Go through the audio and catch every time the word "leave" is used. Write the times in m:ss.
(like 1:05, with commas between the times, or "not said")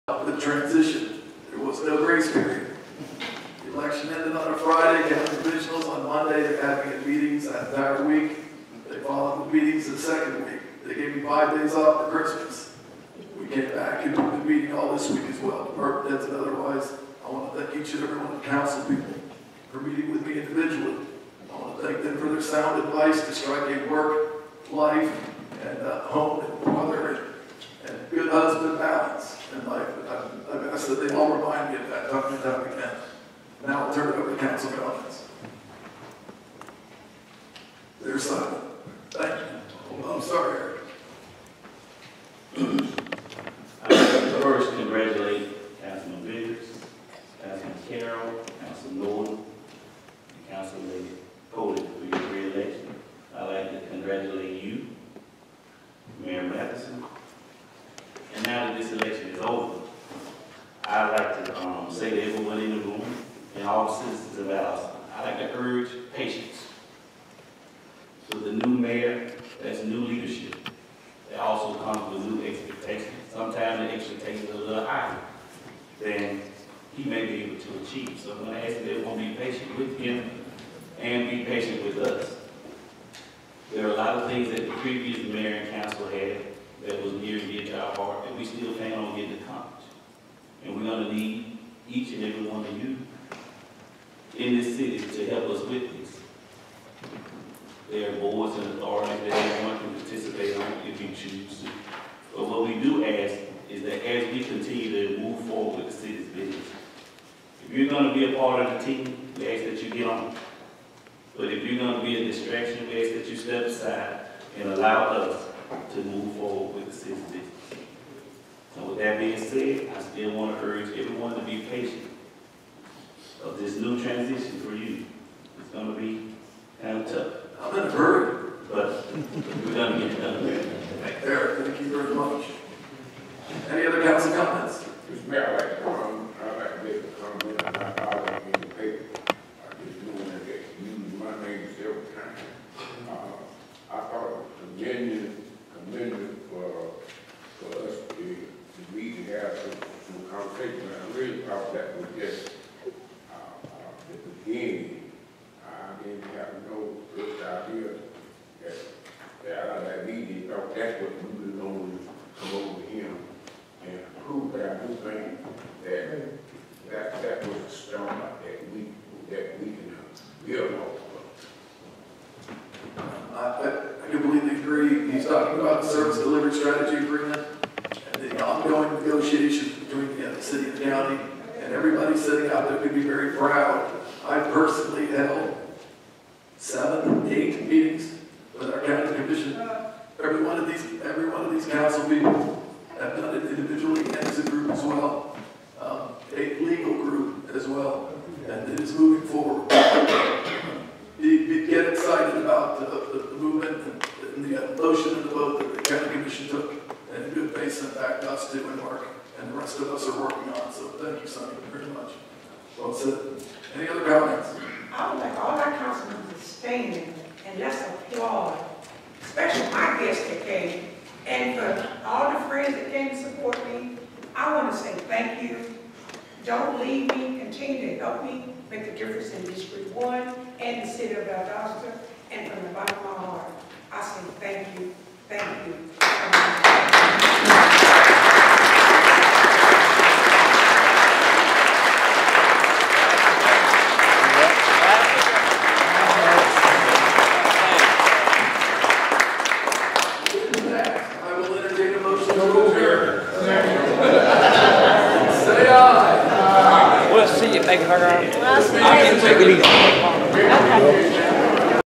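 3:46.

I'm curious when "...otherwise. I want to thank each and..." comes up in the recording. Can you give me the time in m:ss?
0:16.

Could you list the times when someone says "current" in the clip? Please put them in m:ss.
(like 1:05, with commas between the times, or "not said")
not said.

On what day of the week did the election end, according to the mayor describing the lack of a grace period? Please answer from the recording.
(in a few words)
Friday.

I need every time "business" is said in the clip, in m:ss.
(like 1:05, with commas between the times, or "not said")
1:46, 1:57.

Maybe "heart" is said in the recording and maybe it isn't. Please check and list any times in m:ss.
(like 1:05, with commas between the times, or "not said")
1:27, 3:53.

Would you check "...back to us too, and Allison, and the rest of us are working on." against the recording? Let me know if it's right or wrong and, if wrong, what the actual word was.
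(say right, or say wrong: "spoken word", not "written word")
wrong: "Mark", not "Allison".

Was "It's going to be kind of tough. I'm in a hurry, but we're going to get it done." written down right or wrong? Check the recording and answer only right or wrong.
right.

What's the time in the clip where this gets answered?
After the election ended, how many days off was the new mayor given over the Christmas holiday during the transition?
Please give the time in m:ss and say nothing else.
0:11.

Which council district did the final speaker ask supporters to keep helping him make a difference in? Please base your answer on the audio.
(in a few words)
District 1.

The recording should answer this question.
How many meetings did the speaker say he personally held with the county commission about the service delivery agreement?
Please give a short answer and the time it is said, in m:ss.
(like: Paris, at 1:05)
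7 or 8, at 3:06.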